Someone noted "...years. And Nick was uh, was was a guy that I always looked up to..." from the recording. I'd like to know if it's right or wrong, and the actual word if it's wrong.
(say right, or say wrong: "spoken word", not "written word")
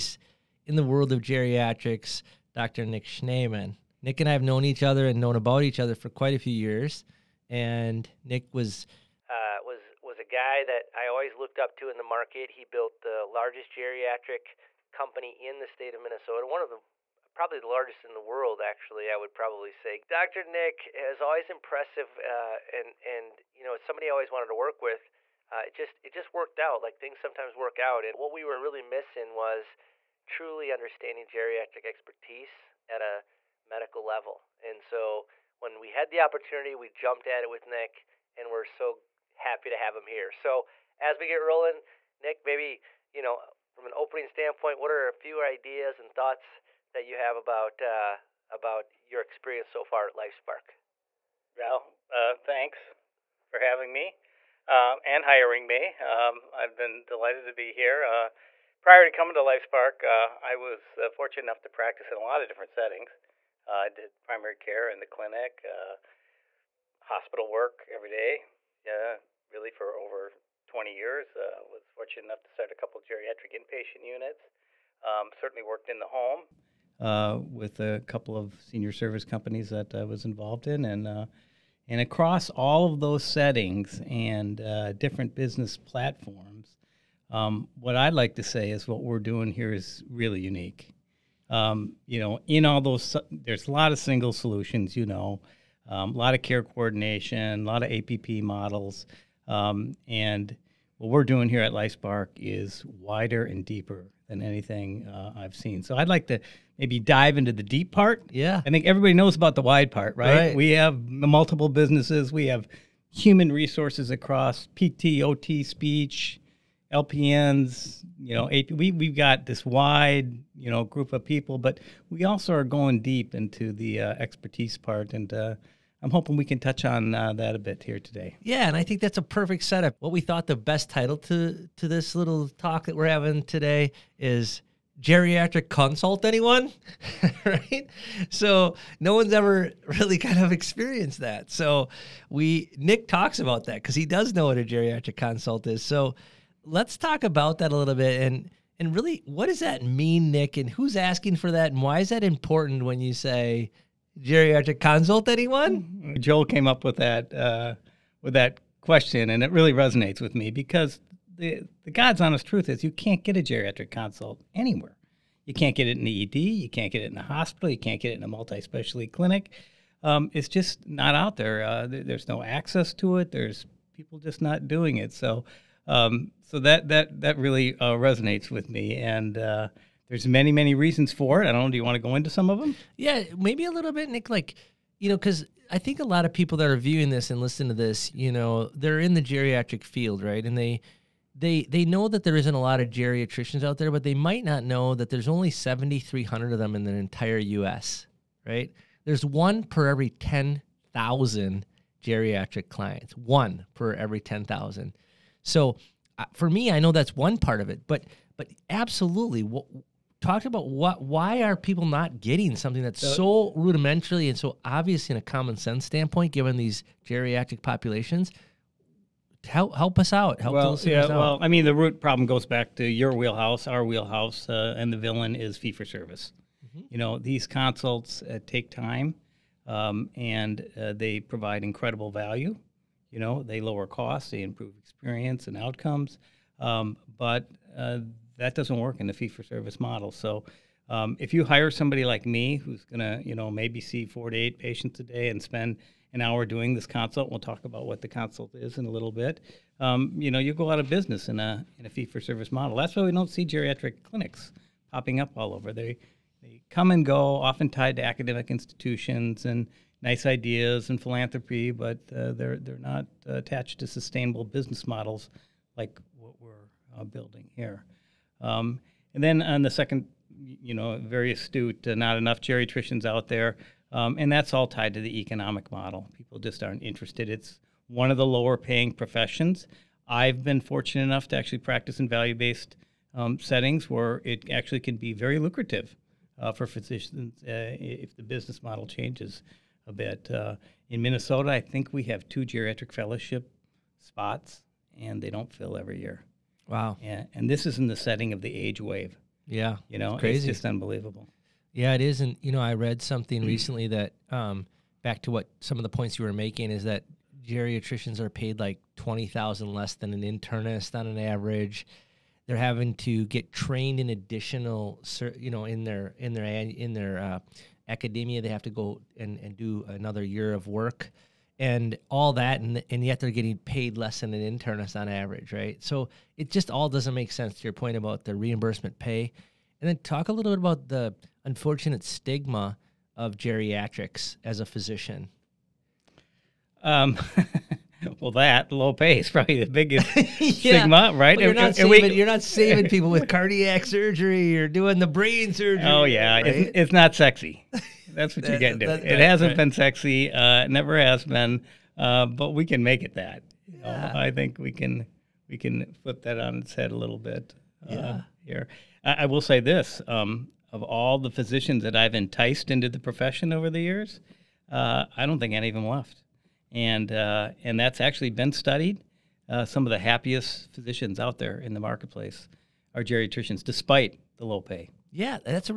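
right.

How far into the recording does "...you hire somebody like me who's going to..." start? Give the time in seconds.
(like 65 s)
241 s.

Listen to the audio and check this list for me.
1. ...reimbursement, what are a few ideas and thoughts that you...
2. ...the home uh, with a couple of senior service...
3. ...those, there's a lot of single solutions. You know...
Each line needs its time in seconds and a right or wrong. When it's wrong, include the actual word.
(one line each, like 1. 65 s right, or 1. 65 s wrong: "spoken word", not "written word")
1. 44 s wrong: "standpoint", not "reimbursement"
2. 75 s right
3. 92 s right.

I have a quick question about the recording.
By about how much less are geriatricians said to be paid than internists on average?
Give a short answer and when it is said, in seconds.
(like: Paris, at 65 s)
20,000, at 308 s.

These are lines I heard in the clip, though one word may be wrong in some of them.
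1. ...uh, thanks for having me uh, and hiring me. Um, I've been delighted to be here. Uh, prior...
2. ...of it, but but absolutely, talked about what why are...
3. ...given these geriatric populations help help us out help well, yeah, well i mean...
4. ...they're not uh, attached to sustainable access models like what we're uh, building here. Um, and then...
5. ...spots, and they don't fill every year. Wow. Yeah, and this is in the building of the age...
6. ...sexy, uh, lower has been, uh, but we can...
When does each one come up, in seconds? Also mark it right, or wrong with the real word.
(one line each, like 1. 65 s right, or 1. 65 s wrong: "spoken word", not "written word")
1. 52 s right
2. 207 s right
3. 216 s right
4. 262 s wrong: "business", not "access"
5. 294 s wrong: "setting", not "building"
6. 349 s wrong: "never", not "lower".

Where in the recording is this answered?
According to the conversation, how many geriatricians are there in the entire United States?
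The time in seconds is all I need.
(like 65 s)
195 s.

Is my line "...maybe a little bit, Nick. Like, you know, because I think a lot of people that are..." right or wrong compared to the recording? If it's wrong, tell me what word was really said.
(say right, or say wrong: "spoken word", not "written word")
right.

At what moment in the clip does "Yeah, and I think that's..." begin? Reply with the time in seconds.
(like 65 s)
128 s.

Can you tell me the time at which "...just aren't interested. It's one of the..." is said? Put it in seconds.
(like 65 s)
276 s.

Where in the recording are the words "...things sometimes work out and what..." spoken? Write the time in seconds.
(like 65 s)
26 s.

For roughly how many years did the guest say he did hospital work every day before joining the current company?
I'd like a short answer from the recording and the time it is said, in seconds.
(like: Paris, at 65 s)
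20, at 70 s.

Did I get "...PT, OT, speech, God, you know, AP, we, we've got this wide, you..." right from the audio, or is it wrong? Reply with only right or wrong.
wrong.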